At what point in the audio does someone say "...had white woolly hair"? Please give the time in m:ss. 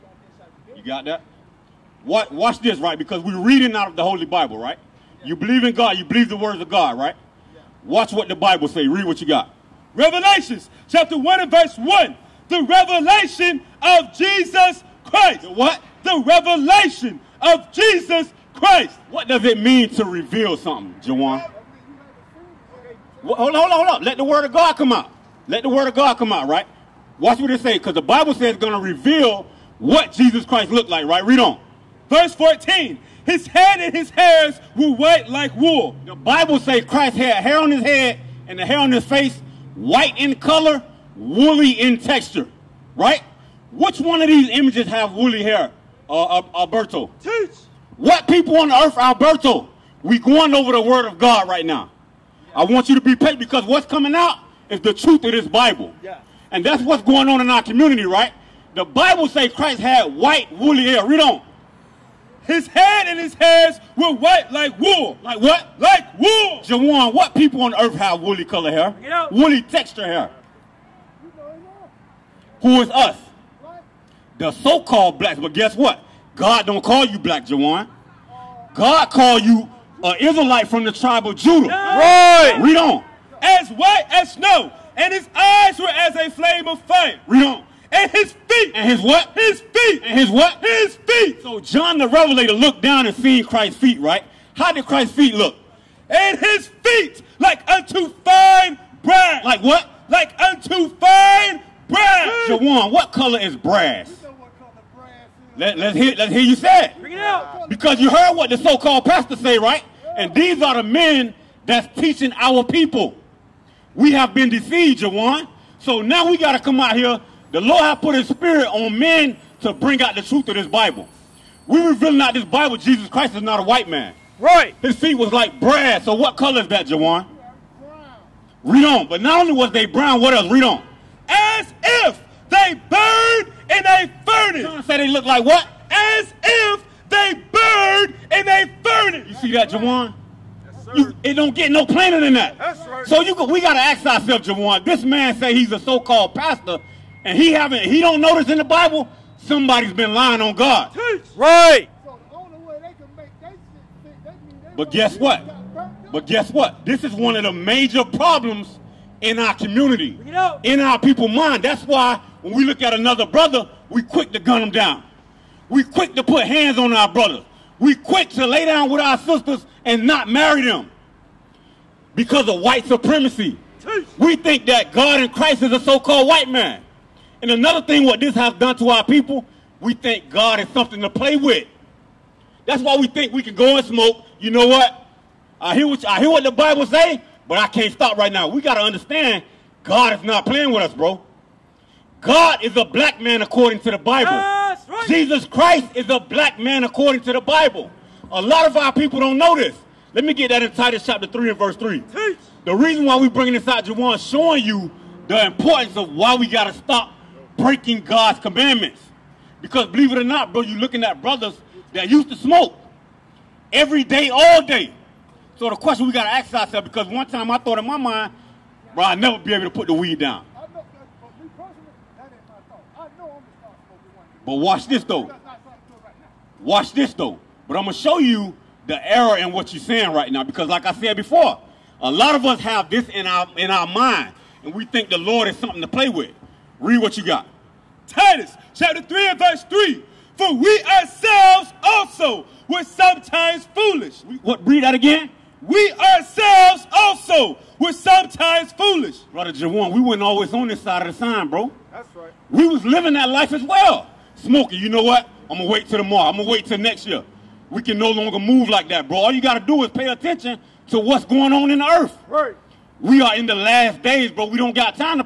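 0:59.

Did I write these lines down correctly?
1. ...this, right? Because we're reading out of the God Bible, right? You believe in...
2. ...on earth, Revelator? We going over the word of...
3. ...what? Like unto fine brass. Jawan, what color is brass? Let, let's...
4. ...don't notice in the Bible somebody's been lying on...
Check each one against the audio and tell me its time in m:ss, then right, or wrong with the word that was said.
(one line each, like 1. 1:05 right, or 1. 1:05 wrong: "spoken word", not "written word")
1. 0:02 wrong: "Holy", not "God"
2. 0:48 wrong: "Alberto", not "Revelator"
3. 1:39 right
4. 2:27 right.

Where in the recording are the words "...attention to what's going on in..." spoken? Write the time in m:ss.
4:20.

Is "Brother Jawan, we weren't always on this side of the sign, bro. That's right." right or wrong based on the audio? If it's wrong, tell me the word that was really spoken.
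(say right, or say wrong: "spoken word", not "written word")
right.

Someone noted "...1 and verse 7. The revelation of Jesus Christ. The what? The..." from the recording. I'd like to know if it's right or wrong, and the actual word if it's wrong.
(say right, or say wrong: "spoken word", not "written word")
wrong: "1", not "7".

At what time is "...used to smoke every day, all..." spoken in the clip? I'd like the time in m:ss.
3:32.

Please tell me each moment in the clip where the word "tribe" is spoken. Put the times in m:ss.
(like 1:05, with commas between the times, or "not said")
1:20.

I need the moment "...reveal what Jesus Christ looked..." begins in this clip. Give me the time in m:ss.
0:28.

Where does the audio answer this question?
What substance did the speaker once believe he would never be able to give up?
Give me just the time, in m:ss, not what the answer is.
3:39.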